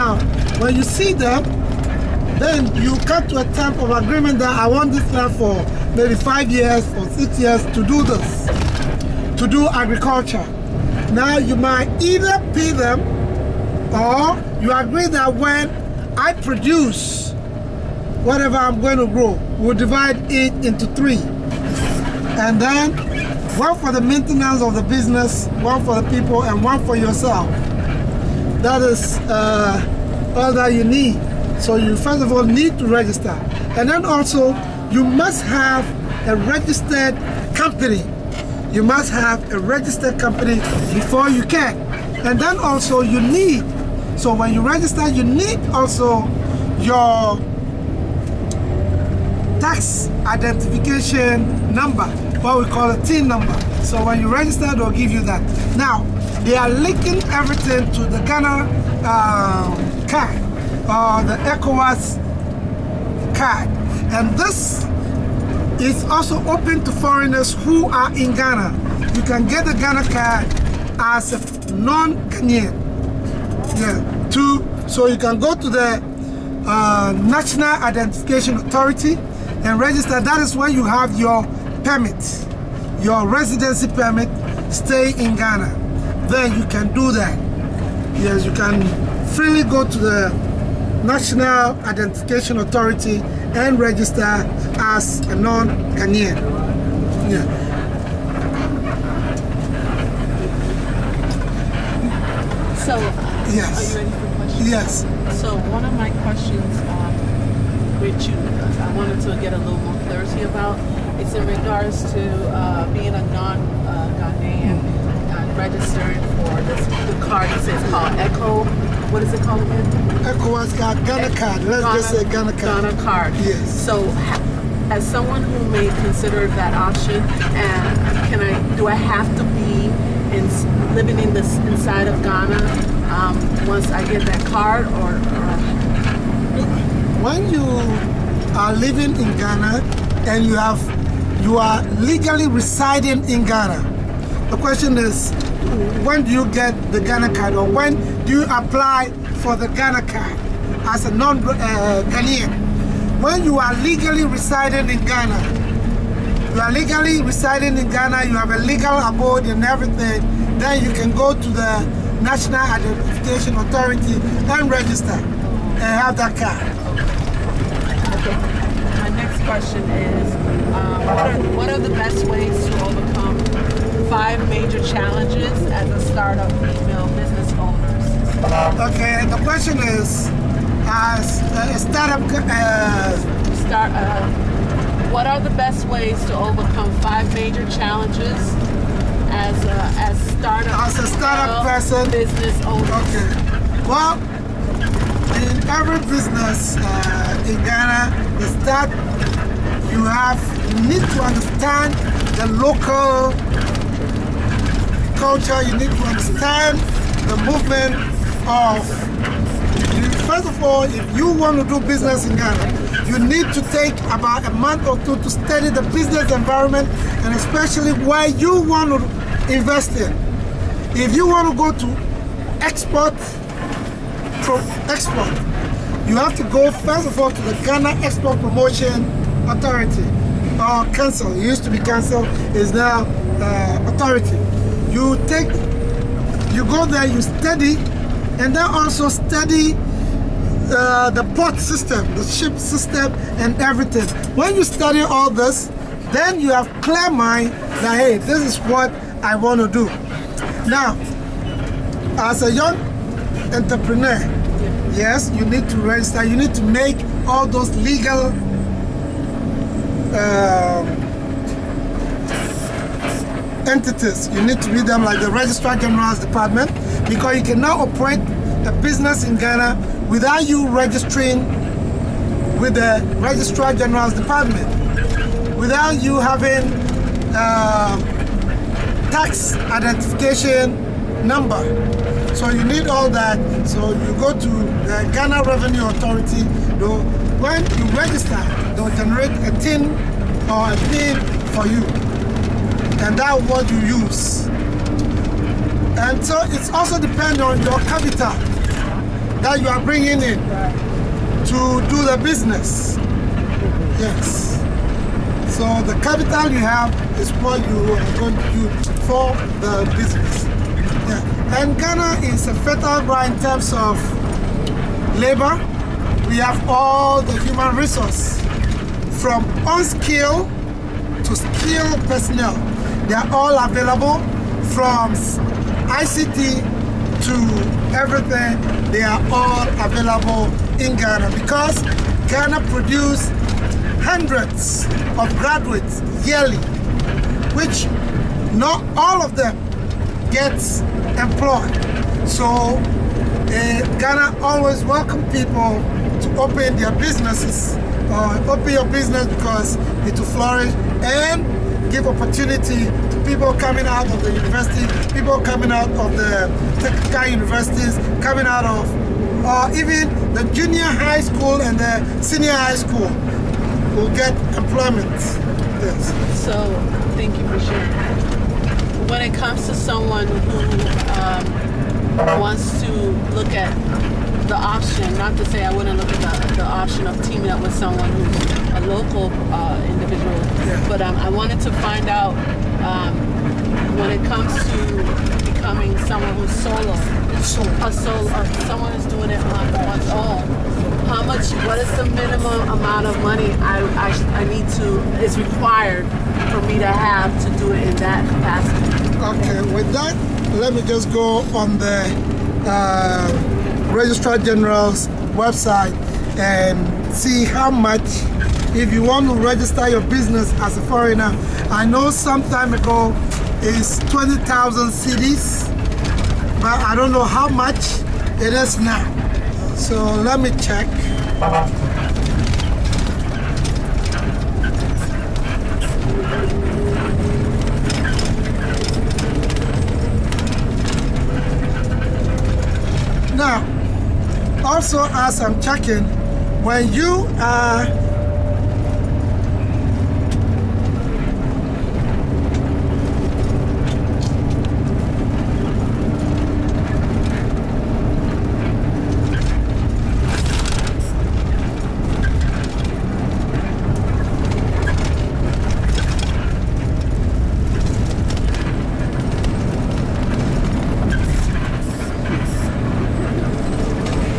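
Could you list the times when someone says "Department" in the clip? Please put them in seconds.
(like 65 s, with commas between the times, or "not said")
266 s, 274 s.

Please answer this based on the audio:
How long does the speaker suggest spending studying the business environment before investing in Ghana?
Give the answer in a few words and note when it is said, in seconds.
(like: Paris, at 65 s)
a month or two, at 214 s.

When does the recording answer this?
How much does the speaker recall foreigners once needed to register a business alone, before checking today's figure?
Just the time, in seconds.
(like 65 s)
414 s.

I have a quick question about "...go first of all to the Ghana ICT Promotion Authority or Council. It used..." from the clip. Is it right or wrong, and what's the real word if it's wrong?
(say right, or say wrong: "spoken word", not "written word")
wrong: "Export", not "ICT".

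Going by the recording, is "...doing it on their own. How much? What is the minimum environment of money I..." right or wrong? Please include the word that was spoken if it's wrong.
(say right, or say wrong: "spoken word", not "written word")
wrong: "amount", not "environment".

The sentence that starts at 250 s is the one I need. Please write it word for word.
Now, as a young entrepreneur, yes, you need to register.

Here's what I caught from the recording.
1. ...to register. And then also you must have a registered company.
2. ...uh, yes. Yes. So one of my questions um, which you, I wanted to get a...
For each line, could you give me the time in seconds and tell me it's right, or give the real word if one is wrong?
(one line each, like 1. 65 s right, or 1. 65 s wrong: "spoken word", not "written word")
1. 32 s right
2. 102 s right.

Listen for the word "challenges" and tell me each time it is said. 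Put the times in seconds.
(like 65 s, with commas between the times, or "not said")
174 s, 187 s.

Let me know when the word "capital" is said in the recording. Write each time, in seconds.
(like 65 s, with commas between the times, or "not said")
297 s, 306 s.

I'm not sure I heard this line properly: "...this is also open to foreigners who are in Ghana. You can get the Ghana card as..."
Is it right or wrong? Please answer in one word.
right.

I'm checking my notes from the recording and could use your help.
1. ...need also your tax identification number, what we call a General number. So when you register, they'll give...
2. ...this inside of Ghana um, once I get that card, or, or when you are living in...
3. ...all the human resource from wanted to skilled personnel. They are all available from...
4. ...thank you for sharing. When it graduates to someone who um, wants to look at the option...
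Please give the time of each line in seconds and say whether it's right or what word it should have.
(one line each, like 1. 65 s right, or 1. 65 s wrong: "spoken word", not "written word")
1. 45 s wrong: "TIN", not "General"
2. 131 s right
3. 316 s wrong: "unskilled", not "wanted"
4. 367 s wrong: "comes", not "graduates".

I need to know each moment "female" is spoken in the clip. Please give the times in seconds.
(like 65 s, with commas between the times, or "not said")
176 s.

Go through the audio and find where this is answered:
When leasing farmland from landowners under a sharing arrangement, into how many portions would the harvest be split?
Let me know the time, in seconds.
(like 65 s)
20 s.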